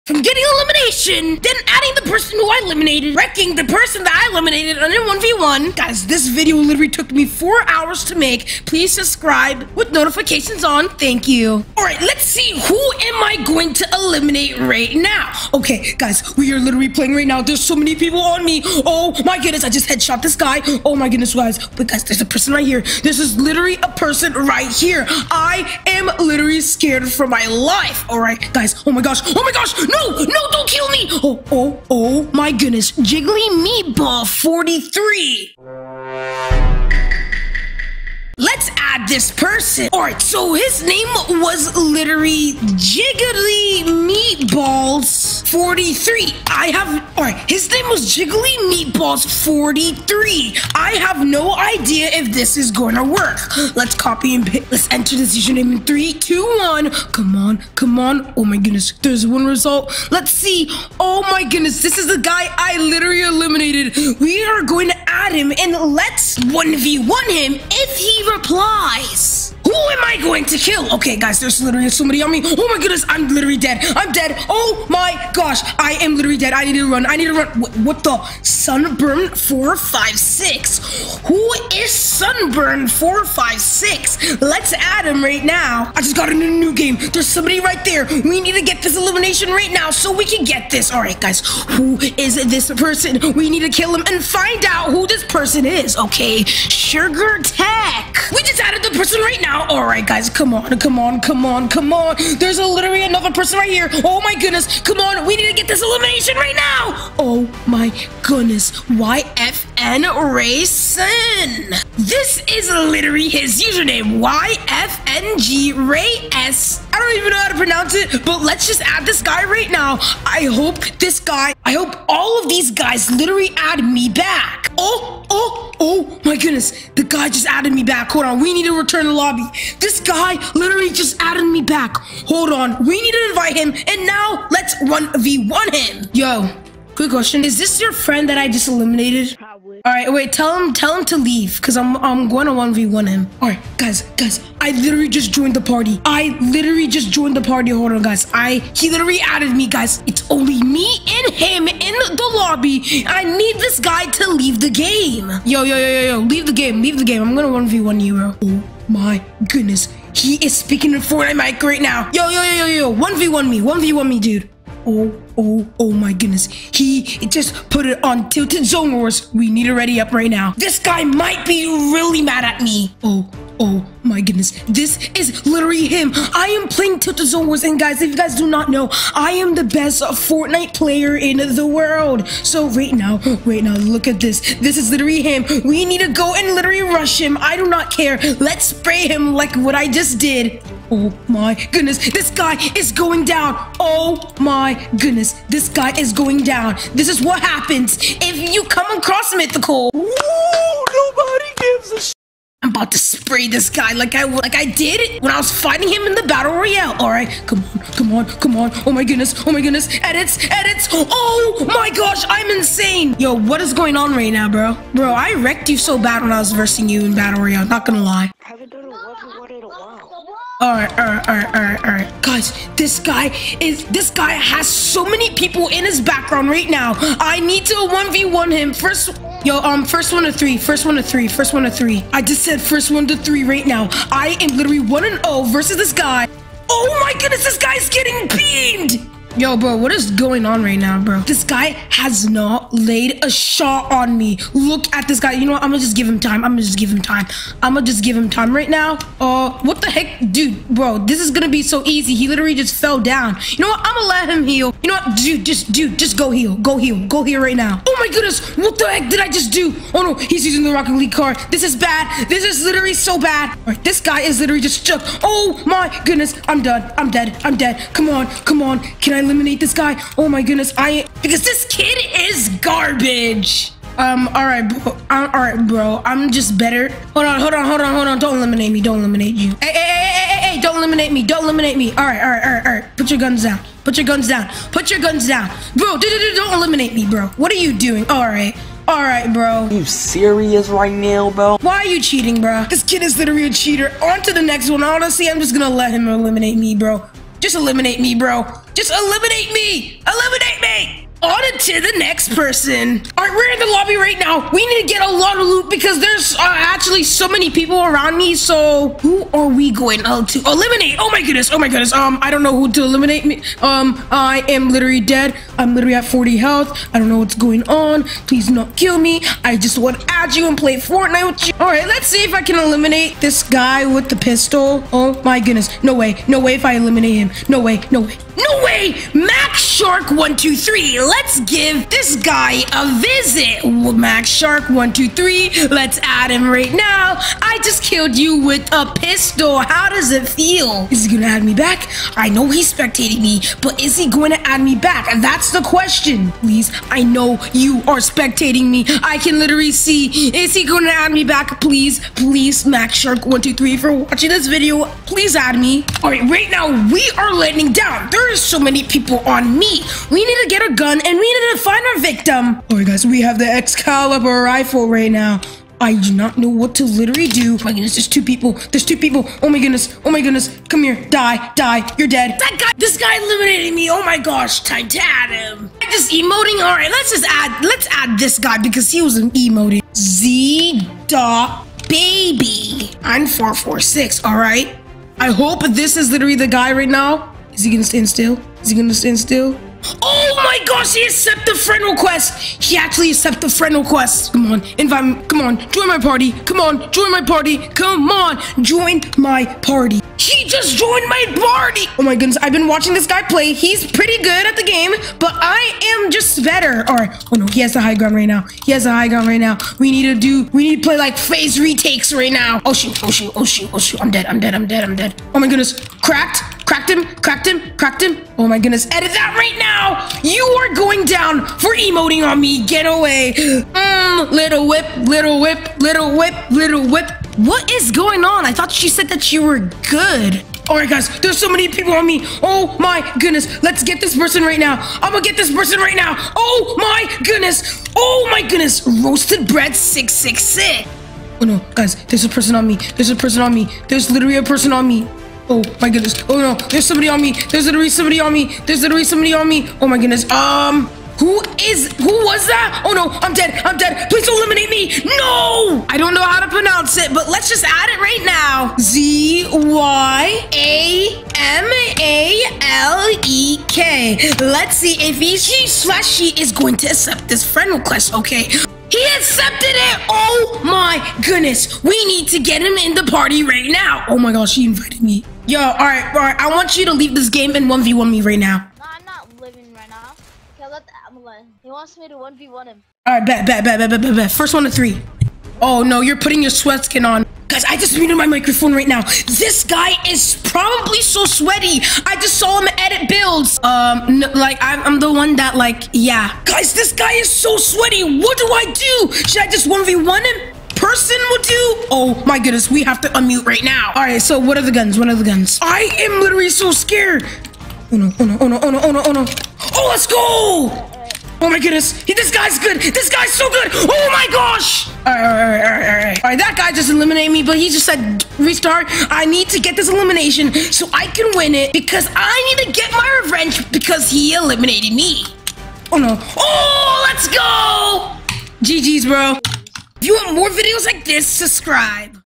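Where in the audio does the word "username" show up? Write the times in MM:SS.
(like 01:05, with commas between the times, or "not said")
00:55, 01:53.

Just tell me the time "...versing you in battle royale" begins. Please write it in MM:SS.
03:36.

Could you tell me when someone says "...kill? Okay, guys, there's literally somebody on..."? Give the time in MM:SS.
01:10.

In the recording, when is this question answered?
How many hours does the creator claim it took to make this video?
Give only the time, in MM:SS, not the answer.
00:07.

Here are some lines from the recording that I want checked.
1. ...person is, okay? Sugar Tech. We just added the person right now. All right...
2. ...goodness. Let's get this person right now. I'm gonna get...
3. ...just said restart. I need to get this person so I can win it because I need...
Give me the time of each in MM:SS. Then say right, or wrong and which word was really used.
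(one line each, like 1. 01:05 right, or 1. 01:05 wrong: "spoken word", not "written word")
1. 01:35 right
2. 07:13 right
3. 08:37 wrong: "elimination", not "person".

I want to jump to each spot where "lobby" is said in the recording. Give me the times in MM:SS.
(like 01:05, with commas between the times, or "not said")
02:09, 02:32, 05:03.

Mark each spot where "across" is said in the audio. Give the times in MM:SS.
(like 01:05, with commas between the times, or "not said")
03:18.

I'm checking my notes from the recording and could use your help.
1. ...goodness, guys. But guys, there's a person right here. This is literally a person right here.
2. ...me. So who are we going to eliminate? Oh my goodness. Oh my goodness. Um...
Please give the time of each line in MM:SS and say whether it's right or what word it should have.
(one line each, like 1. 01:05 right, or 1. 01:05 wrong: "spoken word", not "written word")
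1. 00:21 right
2. 05:08 right.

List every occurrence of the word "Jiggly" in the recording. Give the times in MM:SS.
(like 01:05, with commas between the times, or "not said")
00:32, 00:42, 00:48.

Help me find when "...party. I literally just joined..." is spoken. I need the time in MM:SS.
02:25.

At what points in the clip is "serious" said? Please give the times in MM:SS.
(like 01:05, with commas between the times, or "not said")
04:49.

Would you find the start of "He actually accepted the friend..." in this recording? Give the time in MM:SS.
06:32.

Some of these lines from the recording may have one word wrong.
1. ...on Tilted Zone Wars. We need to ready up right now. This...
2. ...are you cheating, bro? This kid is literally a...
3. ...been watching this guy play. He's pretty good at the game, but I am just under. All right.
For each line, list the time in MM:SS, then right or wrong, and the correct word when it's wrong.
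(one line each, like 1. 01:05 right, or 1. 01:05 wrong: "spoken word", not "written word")
1. 02:48 right
2. 04:51 right
3. 06:42 wrong: "better", not "under".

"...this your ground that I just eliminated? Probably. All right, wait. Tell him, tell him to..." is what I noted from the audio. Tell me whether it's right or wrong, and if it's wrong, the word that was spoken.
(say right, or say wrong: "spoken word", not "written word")
wrong: "friend", not "ground".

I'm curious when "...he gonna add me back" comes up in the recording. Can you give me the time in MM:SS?
05:41.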